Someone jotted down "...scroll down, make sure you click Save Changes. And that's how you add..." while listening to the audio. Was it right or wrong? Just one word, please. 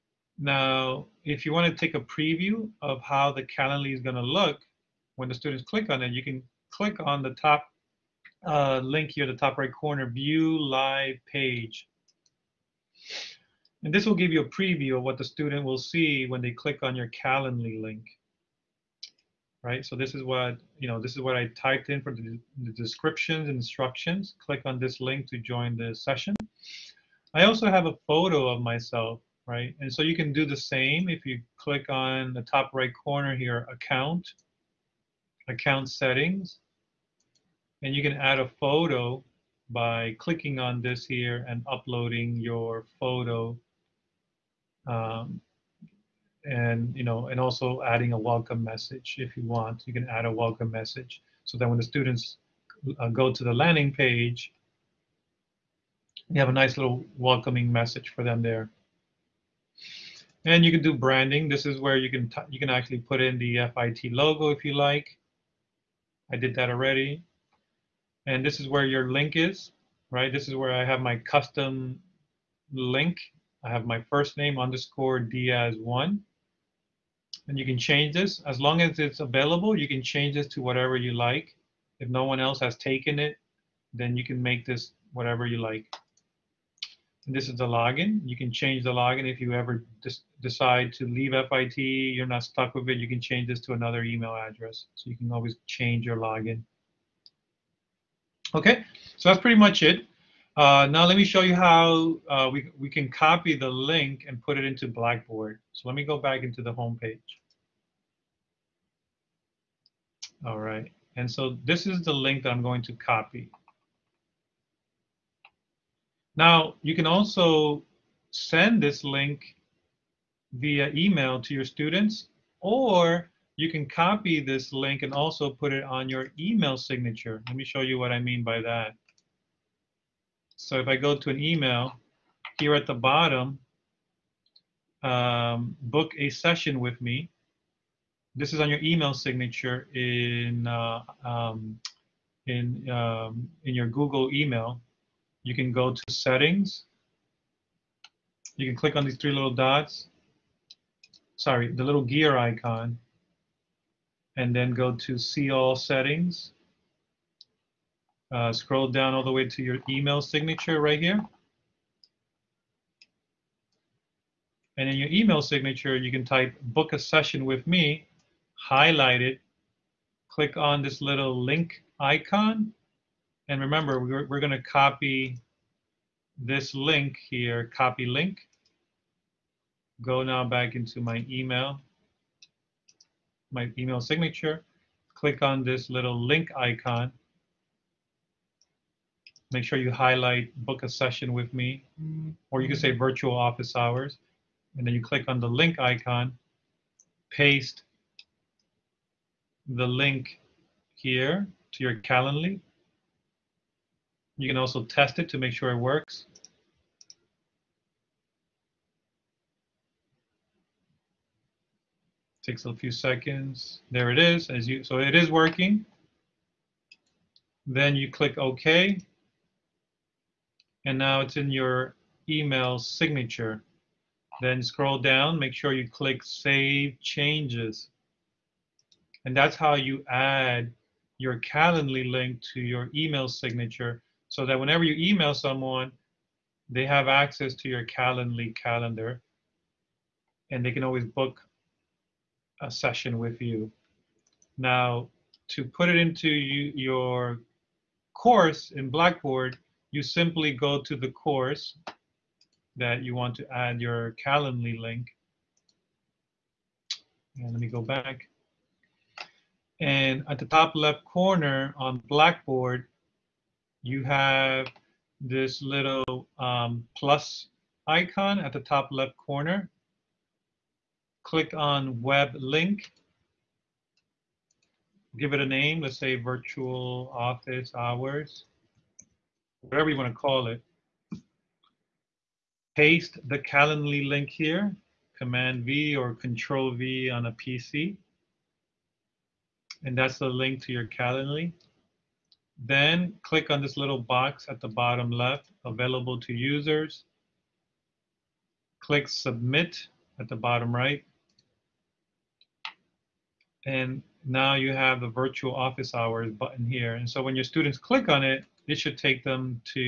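right.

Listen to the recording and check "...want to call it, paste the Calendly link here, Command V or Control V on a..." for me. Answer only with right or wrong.
right.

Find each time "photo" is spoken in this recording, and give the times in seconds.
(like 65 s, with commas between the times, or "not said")
28 s, 38 s, 42 s.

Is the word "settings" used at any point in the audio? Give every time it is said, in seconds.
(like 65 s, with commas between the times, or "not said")
35 s, 146 s, 155 s.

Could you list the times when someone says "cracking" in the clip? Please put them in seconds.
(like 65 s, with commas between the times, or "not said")
not said.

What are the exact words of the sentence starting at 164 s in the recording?
And in your email signature, you can type book a session with me, highlight it, click on this little link icon.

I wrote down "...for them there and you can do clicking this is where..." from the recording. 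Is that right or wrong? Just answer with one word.
wrong.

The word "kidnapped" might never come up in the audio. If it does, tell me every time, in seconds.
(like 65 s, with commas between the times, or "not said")
not said.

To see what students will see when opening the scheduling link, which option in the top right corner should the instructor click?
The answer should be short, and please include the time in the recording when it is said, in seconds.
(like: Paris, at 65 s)
View Live Page, at 10 s.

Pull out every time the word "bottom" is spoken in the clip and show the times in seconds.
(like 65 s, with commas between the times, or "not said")
132 s, 294 s, 300 s.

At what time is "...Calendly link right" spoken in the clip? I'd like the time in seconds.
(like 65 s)
17 s.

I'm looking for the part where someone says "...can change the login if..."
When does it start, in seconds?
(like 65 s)
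88 s.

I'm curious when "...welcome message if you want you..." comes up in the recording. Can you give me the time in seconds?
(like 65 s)
48 s.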